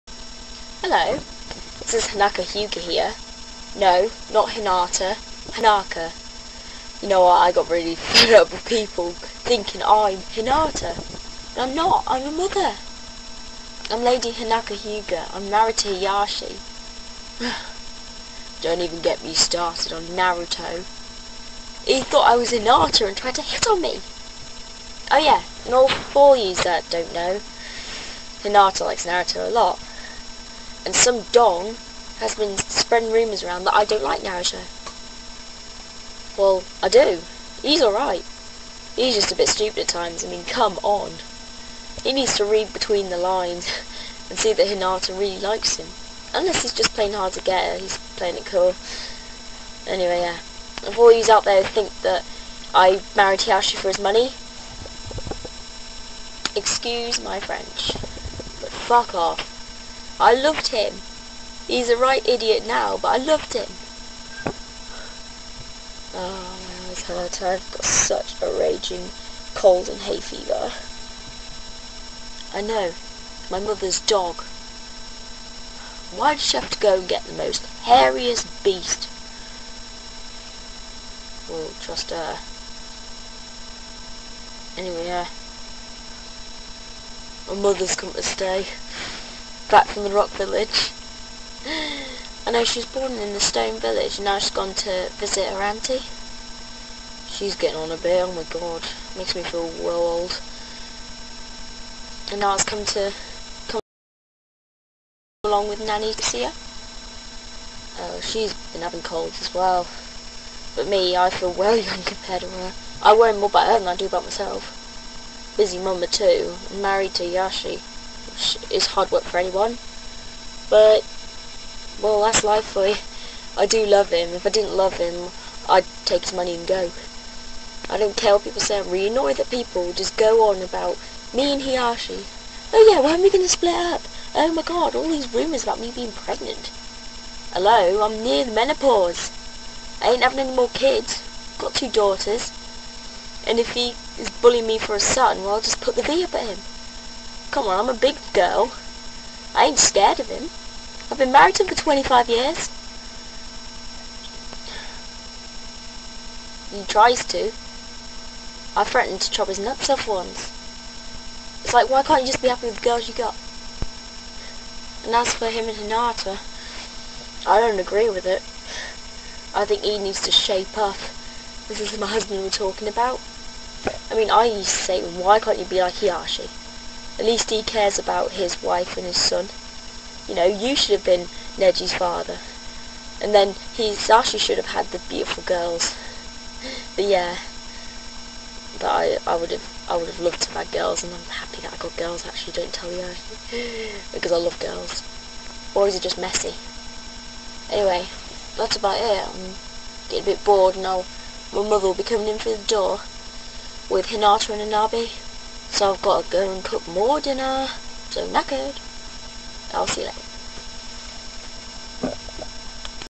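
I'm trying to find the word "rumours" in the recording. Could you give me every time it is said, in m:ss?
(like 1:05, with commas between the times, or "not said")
0:33, 2:15.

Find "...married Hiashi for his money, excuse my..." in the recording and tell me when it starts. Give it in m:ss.
0:53.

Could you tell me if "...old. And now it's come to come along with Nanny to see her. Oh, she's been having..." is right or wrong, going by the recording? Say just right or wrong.
right.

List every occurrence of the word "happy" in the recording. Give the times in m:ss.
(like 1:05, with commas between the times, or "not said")
2:42, 3:11.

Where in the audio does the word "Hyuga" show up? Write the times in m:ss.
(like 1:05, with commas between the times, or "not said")
0:02, 0:14.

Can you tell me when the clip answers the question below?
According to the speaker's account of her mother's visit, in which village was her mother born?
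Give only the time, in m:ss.
1:33.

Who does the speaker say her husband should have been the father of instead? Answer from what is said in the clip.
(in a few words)
Neji.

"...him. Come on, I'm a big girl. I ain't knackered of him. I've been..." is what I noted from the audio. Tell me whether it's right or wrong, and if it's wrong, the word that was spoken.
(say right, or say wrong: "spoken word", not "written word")
wrong: "scared", not "knackered".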